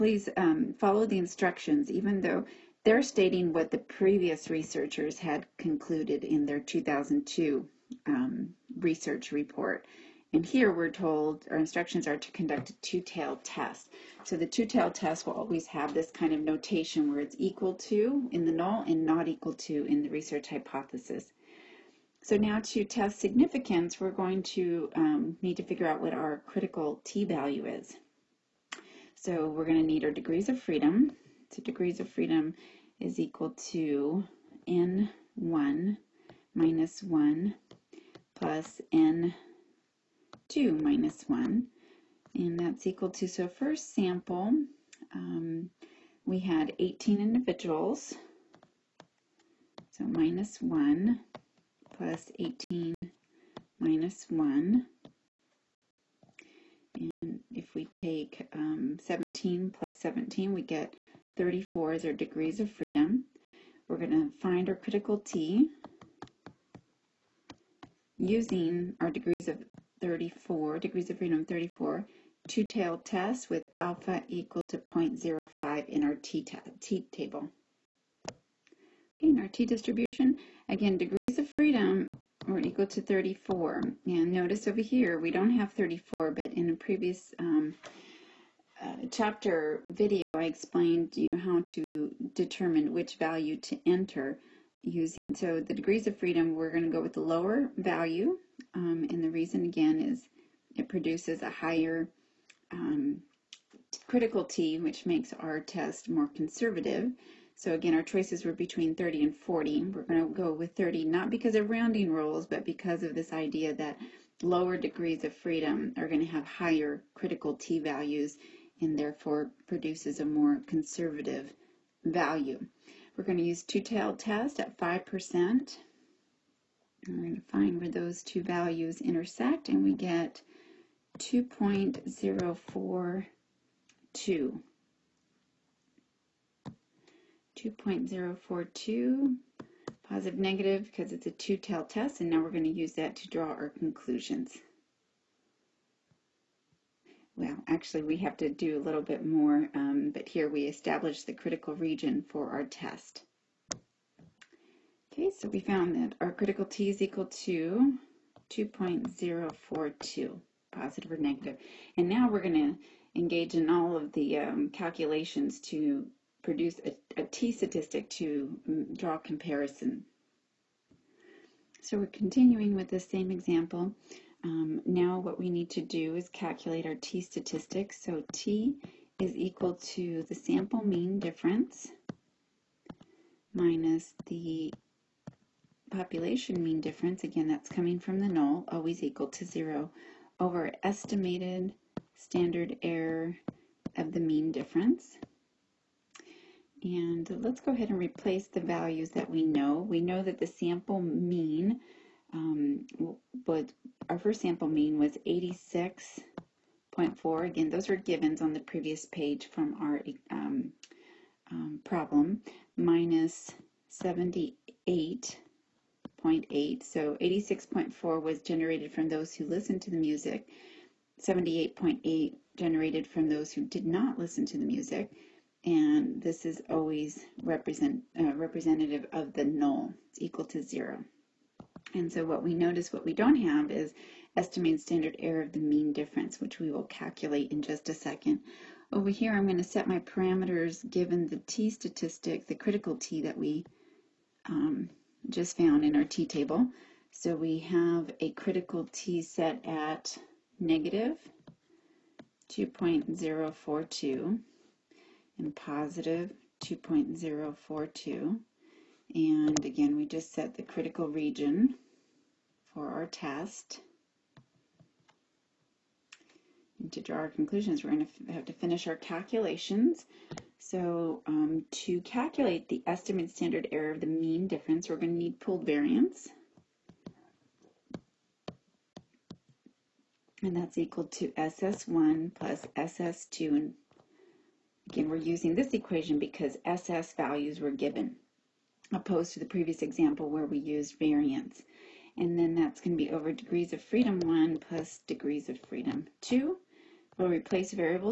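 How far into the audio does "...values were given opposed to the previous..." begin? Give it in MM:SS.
04:47.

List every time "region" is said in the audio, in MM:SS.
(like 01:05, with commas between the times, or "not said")
02:31, 04:21.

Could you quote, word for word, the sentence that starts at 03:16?
And let's go ahead and replace the values that we know.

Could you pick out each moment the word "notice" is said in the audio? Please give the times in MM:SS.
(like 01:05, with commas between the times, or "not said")
01:24, 03:52.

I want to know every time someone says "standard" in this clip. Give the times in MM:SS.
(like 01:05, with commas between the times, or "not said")
03:12, 03:54, 04:33.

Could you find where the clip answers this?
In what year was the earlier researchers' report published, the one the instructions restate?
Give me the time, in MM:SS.
00:06.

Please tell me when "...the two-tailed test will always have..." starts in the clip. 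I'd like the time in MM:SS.
00:14.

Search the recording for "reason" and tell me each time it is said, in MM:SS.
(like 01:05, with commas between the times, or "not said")
01:39.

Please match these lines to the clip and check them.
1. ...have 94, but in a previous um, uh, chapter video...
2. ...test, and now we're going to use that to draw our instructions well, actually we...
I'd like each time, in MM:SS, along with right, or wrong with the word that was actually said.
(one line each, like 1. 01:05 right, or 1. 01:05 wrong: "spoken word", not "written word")
1. 01:25 wrong: "34", not "94"
2. 02:21 wrong: "conclusions", not "instructions".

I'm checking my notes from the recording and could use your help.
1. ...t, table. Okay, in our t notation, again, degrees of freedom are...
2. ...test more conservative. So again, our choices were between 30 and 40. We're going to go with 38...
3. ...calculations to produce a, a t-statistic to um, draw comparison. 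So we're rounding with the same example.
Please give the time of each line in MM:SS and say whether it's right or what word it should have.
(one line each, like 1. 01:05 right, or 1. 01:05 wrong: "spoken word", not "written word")
1. 01:16 wrong: "distribution", not "notation"
2. 01:45 wrong: "30", not "38"
3. 02:44 wrong: "continuing", not "rounding".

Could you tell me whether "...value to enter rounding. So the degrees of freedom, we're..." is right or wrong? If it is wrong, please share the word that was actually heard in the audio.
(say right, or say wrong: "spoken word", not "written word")
wrong: "using", not "rounding".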